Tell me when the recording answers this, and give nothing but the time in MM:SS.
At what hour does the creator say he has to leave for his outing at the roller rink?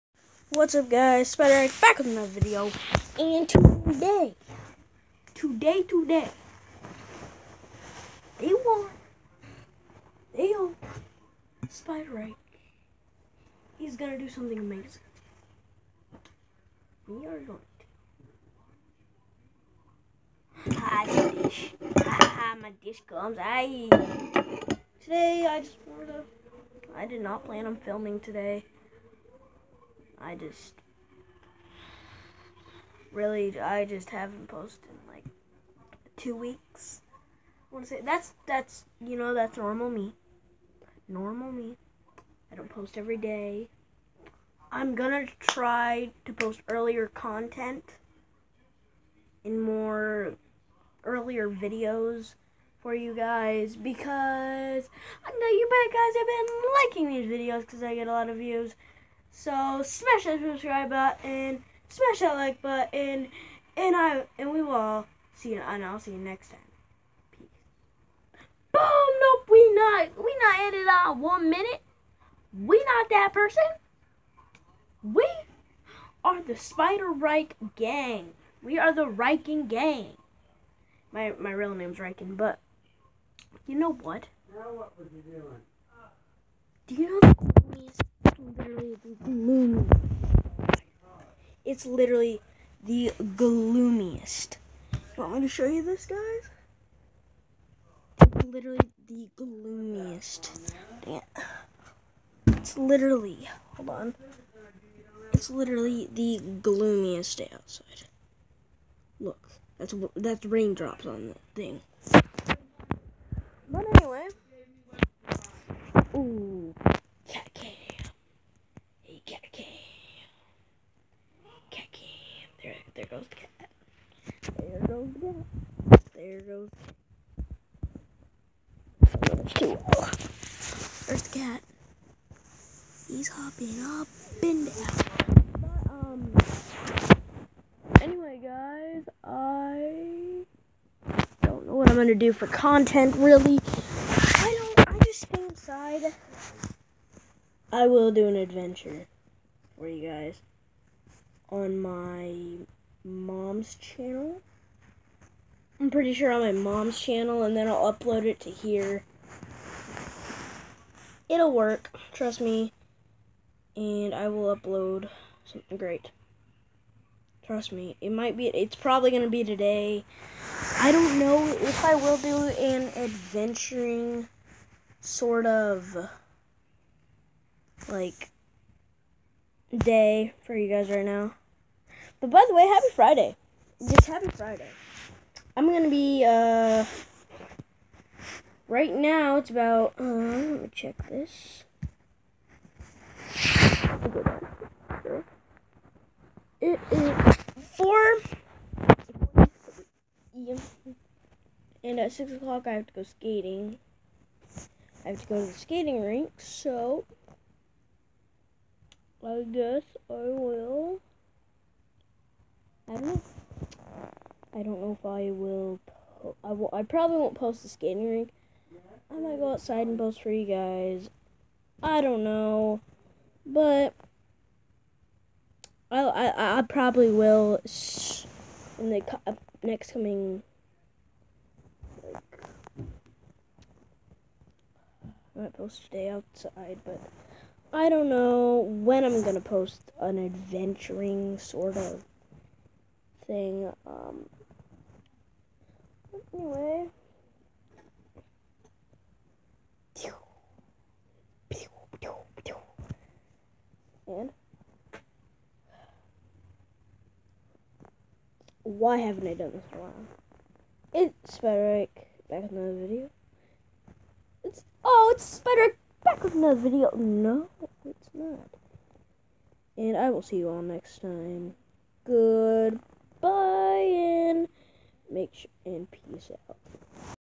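03:22.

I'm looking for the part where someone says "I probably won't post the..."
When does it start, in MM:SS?
03:36.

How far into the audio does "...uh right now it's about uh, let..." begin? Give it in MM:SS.
03:06.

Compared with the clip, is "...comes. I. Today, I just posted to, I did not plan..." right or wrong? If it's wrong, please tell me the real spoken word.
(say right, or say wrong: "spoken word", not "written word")
wrong: "wanted", not "posted".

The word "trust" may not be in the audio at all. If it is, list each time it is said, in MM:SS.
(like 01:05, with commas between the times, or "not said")
02:42, 02:47.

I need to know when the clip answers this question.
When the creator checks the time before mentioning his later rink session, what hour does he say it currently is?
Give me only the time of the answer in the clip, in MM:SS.
03:17.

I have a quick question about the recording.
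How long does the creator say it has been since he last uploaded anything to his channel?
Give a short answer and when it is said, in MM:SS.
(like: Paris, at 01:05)
two weeks, at 00:36.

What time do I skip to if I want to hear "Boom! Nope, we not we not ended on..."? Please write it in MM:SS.
01:08.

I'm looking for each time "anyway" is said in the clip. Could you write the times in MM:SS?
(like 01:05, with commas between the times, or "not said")
02:18, 04:06.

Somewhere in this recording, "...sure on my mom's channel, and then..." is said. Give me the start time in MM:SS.
02:36.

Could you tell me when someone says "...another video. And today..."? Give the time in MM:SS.
00:02.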